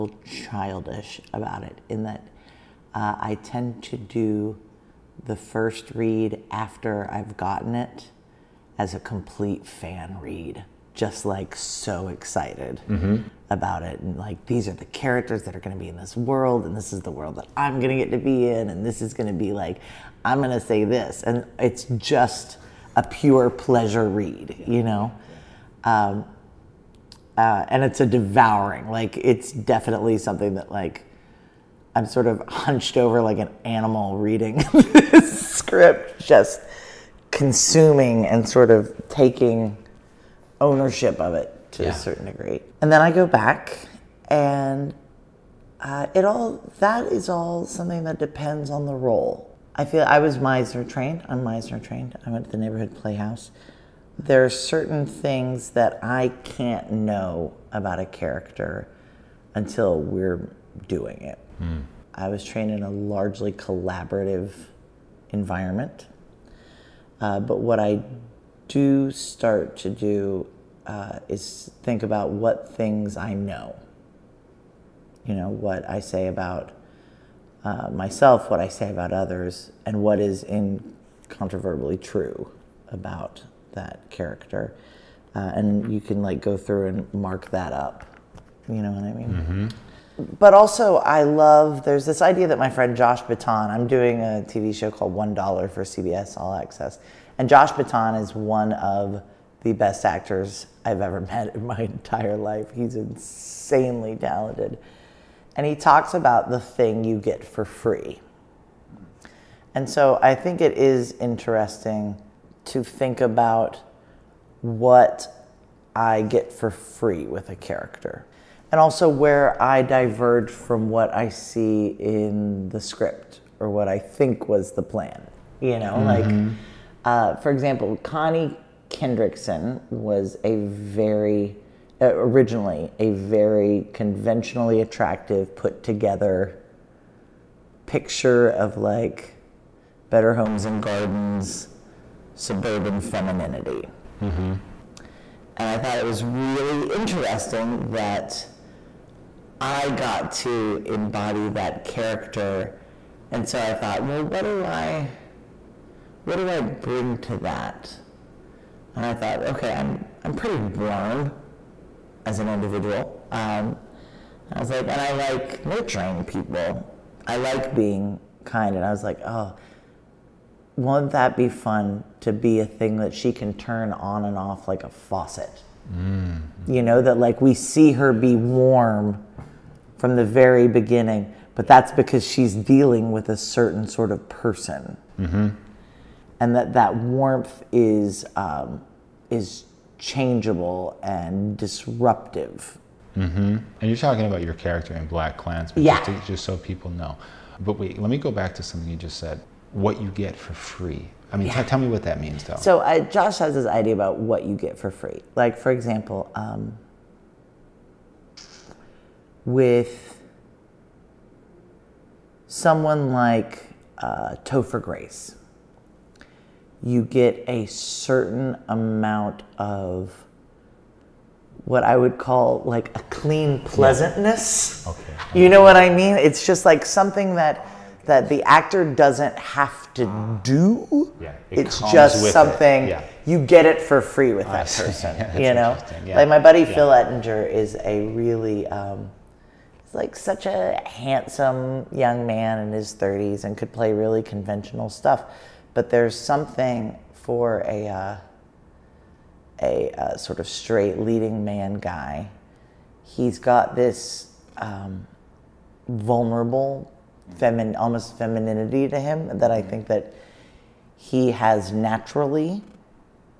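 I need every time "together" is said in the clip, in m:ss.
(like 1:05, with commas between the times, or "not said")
2:15.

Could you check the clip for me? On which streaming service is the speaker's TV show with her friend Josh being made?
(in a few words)
CBS All Access.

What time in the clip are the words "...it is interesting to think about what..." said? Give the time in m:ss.
1:50.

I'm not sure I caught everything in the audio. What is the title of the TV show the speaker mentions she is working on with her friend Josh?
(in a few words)
One Dollar.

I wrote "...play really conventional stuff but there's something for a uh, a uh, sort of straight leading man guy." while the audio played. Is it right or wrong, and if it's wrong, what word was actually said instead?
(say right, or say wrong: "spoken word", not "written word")
right.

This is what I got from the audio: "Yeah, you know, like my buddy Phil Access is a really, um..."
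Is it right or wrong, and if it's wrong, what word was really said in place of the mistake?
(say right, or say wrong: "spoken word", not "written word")
wrong: "Ettinger", not "Access".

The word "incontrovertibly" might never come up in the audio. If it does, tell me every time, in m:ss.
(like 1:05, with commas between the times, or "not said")
1:20.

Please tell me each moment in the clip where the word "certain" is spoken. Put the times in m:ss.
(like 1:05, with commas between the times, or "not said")
0:41, 0:54, 3:03, 3:37.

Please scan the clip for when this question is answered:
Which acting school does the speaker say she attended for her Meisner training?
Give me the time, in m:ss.
0:52.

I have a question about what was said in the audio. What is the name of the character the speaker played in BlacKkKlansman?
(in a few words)
Connie Kendrickson.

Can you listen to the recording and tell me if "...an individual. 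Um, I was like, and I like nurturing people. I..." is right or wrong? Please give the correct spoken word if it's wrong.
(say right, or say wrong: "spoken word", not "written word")
right.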